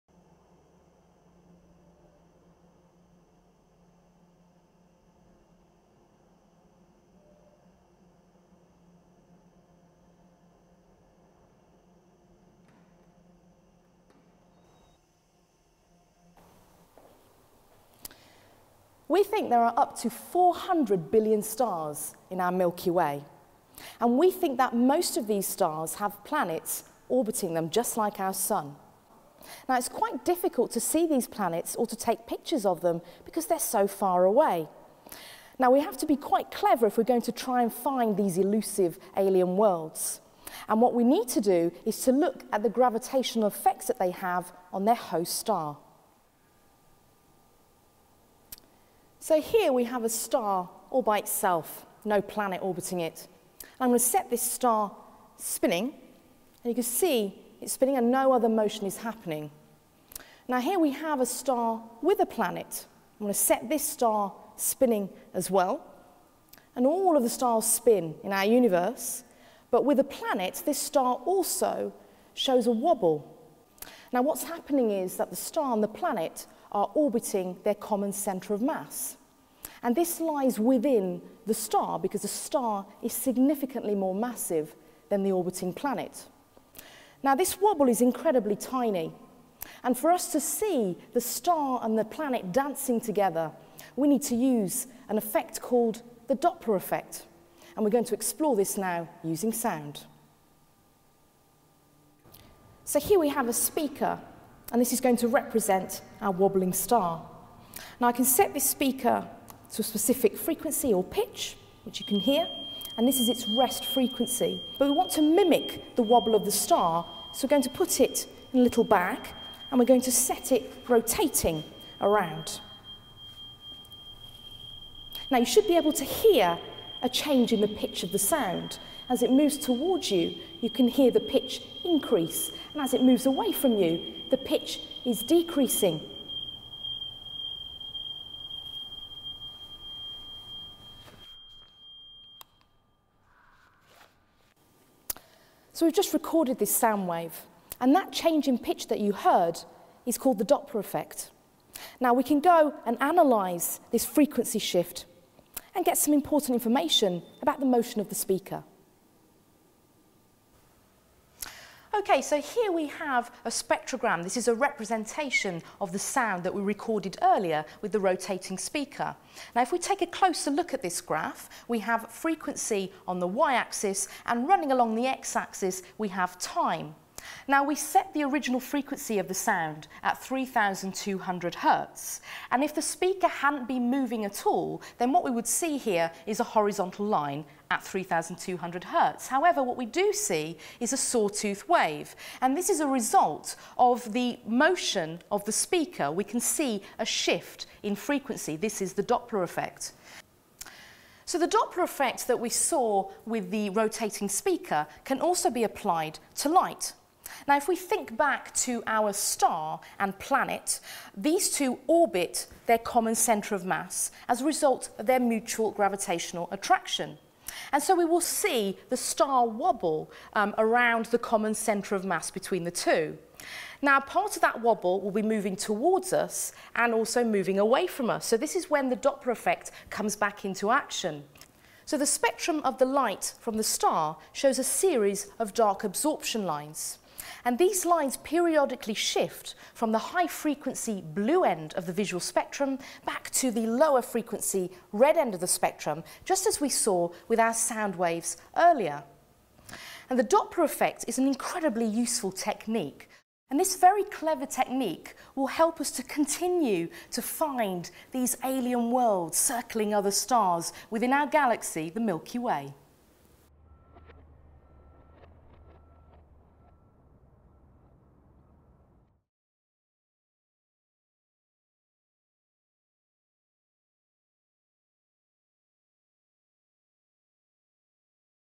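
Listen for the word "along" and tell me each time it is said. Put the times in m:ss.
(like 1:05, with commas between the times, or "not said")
2:54.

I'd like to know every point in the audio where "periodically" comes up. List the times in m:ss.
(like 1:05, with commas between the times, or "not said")
3:58.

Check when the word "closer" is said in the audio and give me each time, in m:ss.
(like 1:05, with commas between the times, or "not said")
2:50.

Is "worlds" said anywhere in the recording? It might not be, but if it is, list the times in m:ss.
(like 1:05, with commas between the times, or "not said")
0:39, 4:18.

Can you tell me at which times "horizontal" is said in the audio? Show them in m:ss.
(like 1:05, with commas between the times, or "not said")
3:06.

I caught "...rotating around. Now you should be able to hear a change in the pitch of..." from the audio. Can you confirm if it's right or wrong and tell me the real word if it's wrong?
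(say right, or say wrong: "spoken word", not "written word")
right.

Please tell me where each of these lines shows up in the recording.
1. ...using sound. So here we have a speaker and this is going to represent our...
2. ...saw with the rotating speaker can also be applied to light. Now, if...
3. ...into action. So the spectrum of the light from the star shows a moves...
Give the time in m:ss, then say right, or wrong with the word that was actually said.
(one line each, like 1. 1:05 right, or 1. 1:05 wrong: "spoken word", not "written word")
1. 1:39 right
2. 3:22 right
3. 3:50 wrong: "series", not "moves".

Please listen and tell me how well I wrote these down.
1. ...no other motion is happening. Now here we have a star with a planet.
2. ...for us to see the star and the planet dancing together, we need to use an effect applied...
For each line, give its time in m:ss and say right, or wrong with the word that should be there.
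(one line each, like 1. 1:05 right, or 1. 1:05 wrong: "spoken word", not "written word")
1. 0:58 right
2. 1:29 wrong: "called", not "applied".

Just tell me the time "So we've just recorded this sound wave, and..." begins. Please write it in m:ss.
2:25.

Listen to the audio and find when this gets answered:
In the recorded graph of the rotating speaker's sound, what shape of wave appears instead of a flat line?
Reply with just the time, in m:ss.
3:10.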